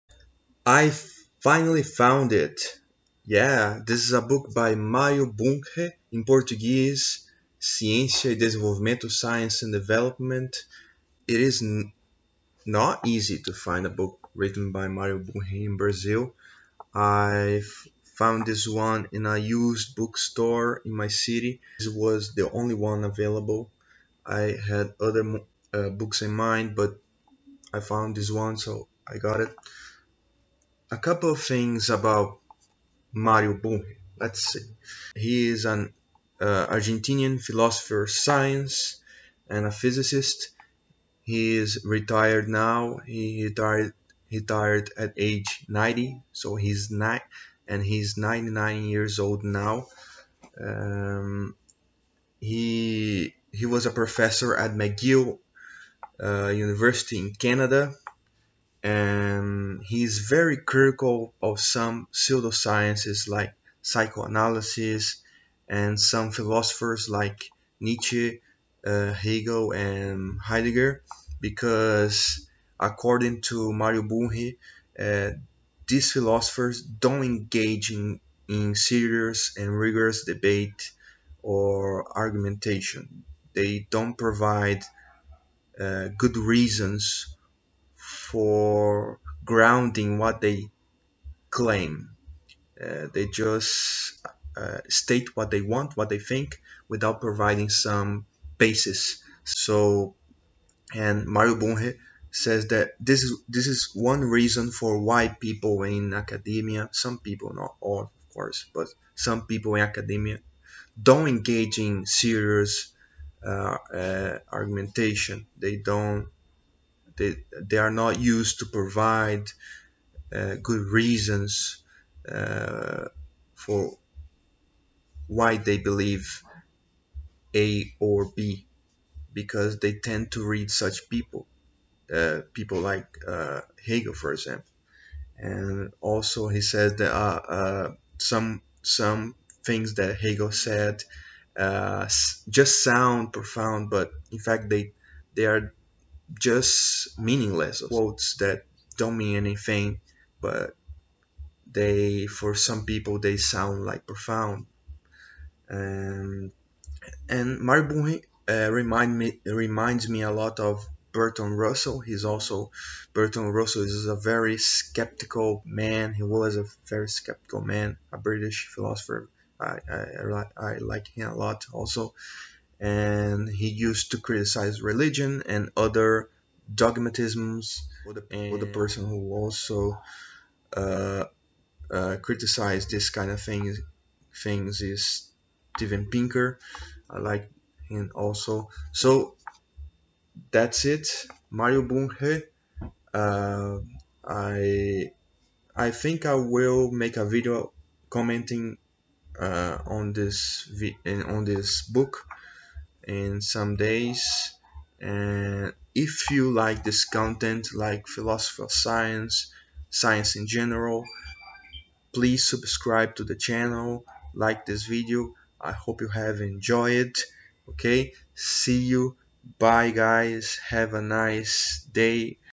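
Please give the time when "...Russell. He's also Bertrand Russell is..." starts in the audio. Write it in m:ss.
2:41.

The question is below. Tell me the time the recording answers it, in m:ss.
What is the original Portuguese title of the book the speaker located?
0:07.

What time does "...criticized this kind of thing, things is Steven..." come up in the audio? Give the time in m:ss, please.
3:02.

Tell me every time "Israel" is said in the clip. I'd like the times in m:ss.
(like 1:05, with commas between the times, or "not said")
not said.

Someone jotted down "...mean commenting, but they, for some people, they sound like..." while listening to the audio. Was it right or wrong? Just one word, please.
wrong.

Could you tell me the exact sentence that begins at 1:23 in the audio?
They don't provide uh, good reasons for grounding what they claim.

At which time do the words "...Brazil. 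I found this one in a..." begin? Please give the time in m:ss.
0:15.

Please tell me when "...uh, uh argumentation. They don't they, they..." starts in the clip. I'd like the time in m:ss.
1:53.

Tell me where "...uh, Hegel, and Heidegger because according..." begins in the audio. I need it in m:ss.
1:08.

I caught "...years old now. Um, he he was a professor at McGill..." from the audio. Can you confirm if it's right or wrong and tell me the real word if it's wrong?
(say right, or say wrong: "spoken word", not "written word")
right.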